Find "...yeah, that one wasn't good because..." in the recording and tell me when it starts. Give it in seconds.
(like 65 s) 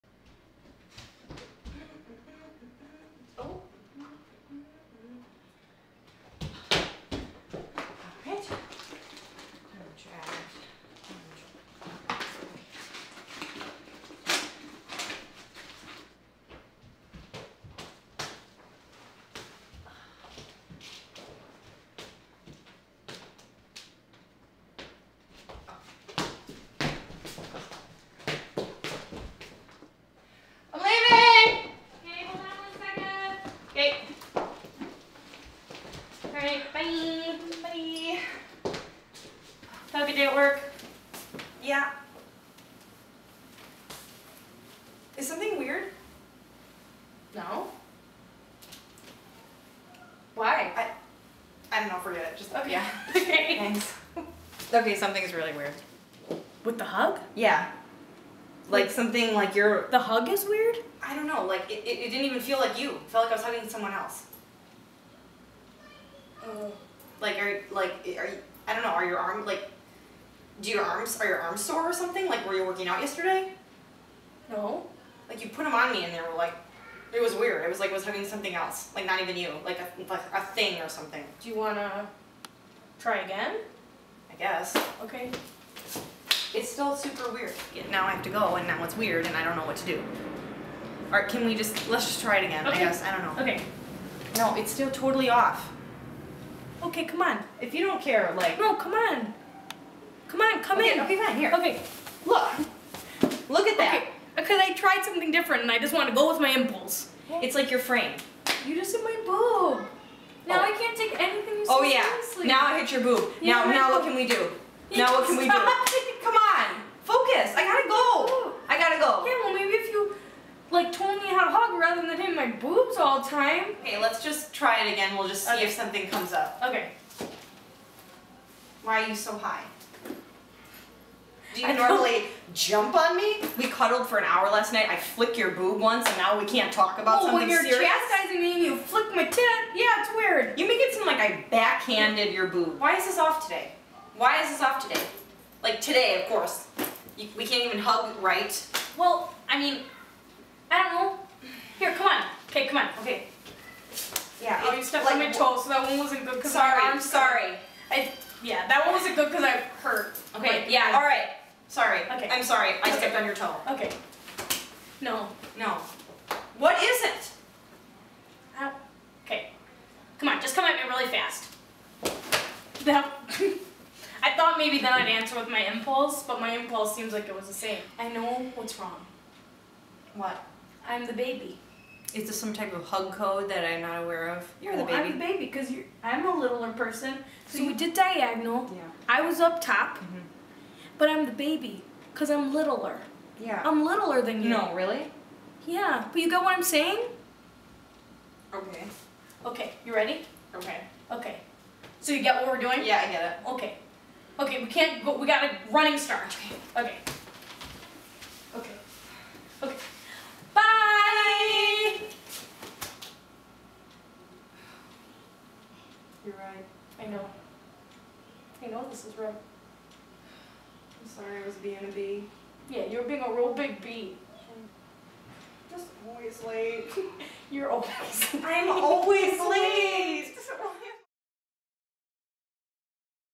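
158 s.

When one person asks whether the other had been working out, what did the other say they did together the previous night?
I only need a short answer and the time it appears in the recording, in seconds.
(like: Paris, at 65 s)
cuddled for an hour, at 133 s.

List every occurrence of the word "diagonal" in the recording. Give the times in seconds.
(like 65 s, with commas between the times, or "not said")
187 s.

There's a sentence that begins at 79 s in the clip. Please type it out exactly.
Like a like a thing or something.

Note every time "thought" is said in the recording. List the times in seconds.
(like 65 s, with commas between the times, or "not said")
174 s.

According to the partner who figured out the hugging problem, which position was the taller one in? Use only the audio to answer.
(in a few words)
up top.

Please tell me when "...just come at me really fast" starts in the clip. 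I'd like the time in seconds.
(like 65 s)
170 s.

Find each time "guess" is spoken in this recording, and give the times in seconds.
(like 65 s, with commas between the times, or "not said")
84 s, 92 s.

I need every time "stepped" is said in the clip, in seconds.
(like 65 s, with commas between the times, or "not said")
154 s, 162 s.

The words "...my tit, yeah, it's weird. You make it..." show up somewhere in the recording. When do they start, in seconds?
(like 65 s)
139 s.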